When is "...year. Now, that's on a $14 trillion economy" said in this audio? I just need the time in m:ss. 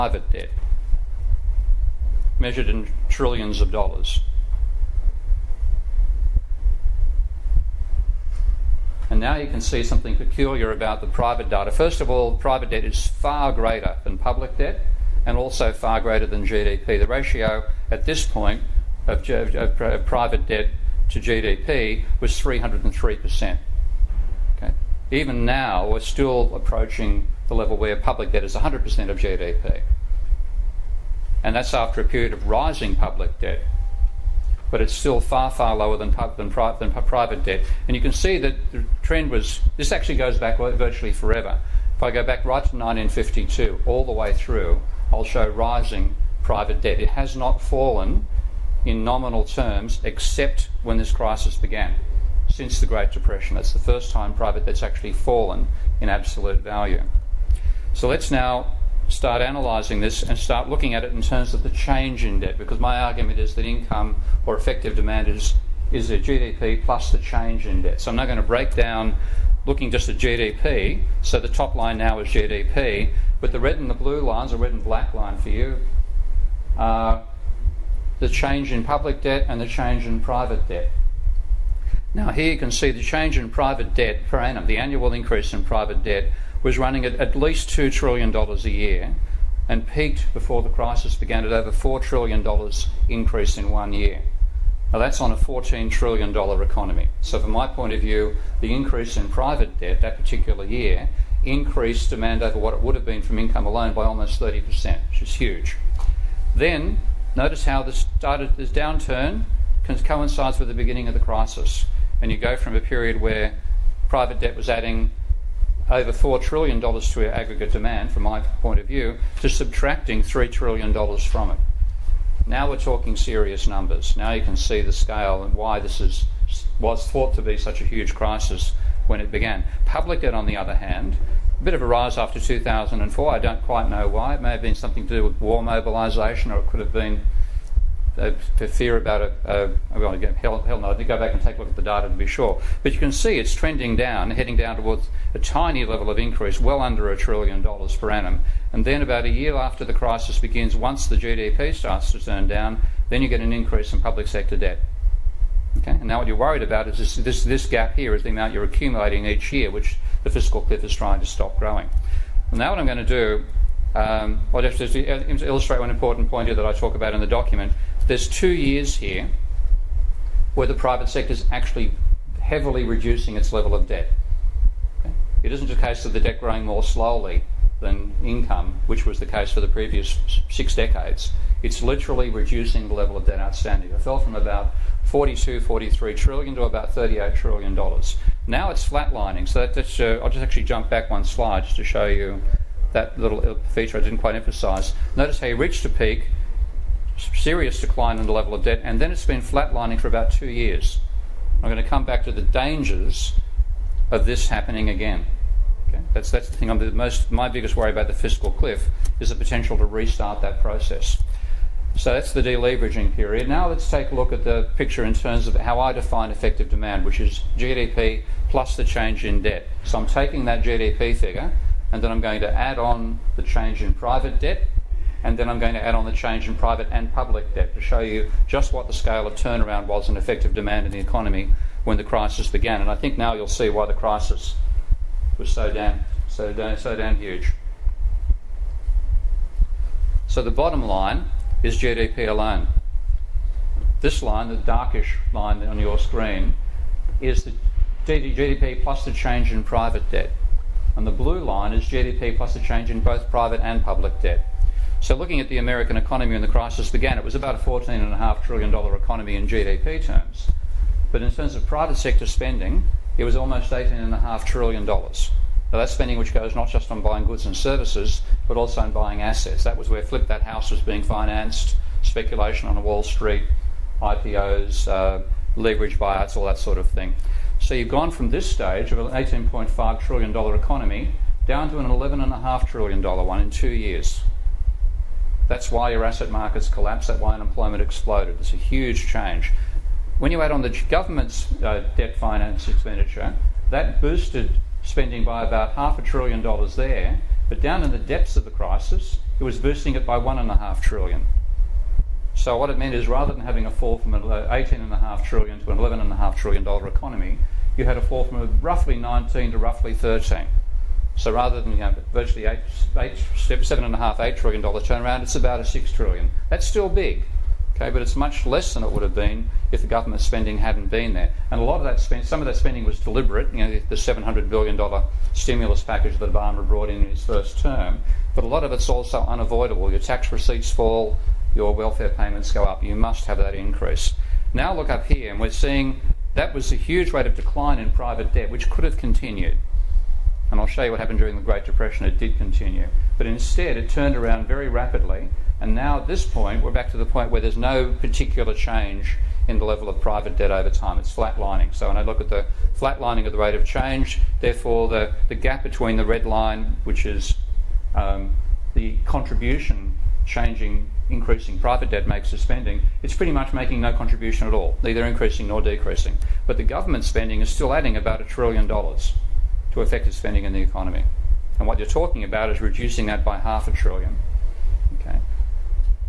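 1:33.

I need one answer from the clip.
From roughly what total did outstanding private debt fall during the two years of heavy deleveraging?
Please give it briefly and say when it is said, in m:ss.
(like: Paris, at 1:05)
42 to 43 trillion dollars, at 3:04.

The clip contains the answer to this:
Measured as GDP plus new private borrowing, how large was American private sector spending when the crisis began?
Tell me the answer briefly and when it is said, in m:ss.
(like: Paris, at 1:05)
$18.5 trillion, at 4:23.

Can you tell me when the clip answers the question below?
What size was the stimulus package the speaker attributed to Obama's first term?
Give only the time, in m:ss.
5:23.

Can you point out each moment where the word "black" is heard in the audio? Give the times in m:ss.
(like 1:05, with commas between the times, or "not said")
1:14.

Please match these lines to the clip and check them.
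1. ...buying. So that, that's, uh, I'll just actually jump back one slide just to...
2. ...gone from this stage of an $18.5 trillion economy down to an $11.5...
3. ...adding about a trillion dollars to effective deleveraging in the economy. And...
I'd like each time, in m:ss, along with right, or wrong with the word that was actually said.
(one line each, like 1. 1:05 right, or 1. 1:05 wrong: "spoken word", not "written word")
1. 3:08 wrong: "flatlining", not "buying"
2. 4:37 right
3. 6:07 wrong: "spending", not "deleveraging".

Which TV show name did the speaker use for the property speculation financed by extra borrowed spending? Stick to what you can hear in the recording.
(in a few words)
Flip That House.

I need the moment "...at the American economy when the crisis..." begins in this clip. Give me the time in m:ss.
4:15.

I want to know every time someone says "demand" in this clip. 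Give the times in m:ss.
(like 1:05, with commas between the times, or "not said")
1:04, 1:42, 1:57, 3:36, 3:50.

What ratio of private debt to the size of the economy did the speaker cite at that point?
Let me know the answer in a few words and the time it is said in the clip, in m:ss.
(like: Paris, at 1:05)
303%, at 0:22.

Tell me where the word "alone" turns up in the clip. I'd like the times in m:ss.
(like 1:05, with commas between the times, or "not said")
1:43, 4:02.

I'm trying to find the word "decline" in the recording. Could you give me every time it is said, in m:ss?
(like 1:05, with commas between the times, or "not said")
3:17, 5:37.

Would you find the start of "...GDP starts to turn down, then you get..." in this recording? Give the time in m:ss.
2:31.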